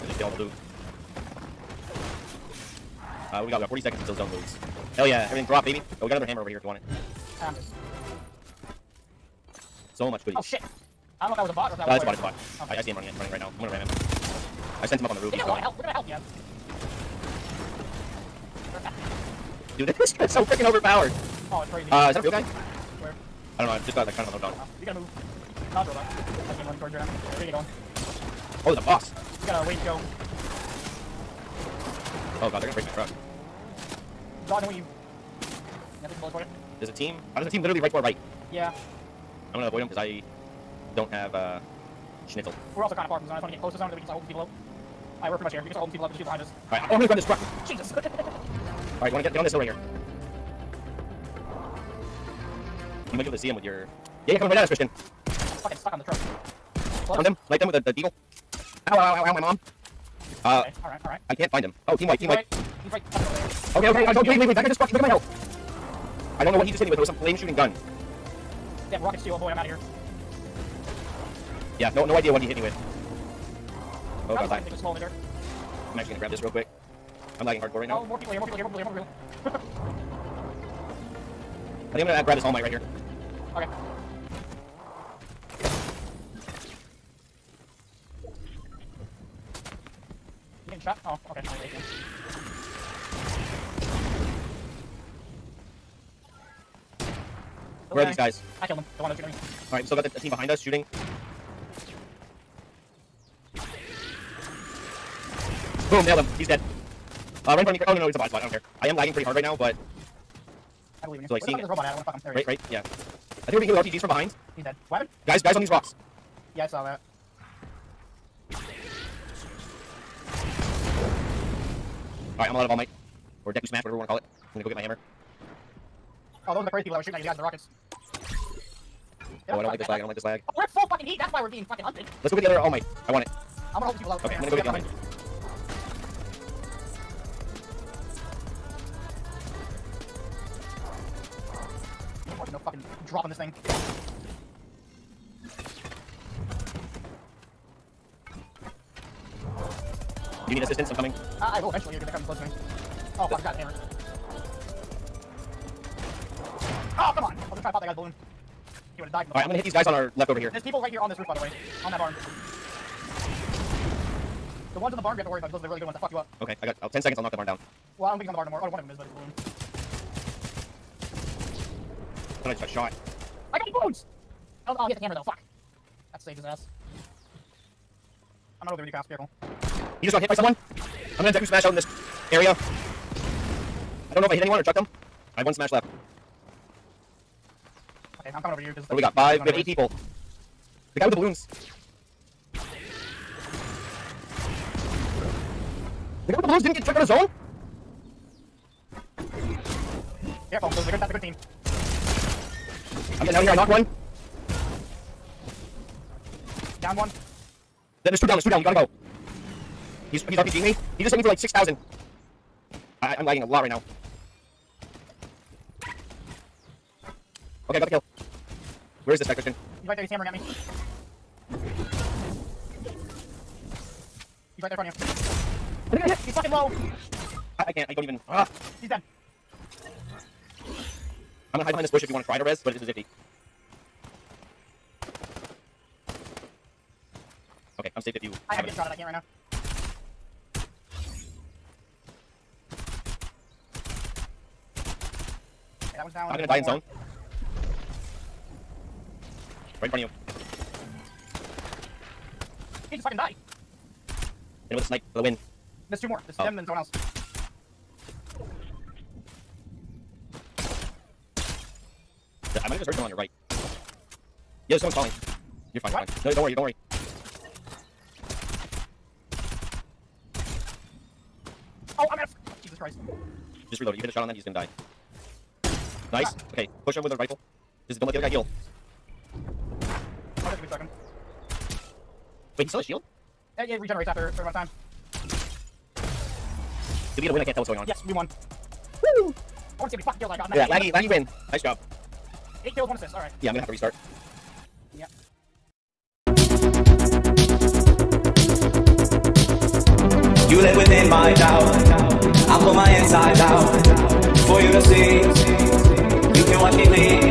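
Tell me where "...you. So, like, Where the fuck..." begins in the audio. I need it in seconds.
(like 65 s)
111 s.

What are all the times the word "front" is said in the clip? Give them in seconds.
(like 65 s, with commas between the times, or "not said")
107 s, 224 s, 249 s.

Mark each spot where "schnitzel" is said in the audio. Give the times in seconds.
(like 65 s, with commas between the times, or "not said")
42 s.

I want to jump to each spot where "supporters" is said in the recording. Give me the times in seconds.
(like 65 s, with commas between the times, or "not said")
not said.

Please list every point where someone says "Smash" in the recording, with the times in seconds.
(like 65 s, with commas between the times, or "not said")
123 s, 181 s, 185 s.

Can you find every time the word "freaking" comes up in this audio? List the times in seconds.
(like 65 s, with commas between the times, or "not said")
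20 s.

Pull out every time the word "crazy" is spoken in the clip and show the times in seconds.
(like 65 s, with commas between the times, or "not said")
21 s, 126 s.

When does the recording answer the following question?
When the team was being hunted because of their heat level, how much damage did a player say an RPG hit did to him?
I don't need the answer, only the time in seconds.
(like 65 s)
211 s.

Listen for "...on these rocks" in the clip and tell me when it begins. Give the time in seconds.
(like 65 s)
115 s.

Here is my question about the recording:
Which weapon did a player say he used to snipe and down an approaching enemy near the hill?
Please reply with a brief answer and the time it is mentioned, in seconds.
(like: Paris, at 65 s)
the deagle, at 57 s.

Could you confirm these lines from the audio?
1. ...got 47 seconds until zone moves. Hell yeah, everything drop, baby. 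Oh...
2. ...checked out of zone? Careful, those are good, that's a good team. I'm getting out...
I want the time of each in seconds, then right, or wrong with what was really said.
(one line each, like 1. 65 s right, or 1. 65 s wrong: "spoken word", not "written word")
1. 3 s wrong: "40", not "47"
2. 196 s right.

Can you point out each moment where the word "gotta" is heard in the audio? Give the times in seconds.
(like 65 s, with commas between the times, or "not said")
24 s, 208 s.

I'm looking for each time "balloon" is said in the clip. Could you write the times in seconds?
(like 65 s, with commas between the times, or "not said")
157 s, 169 s, 191 s, 196 s.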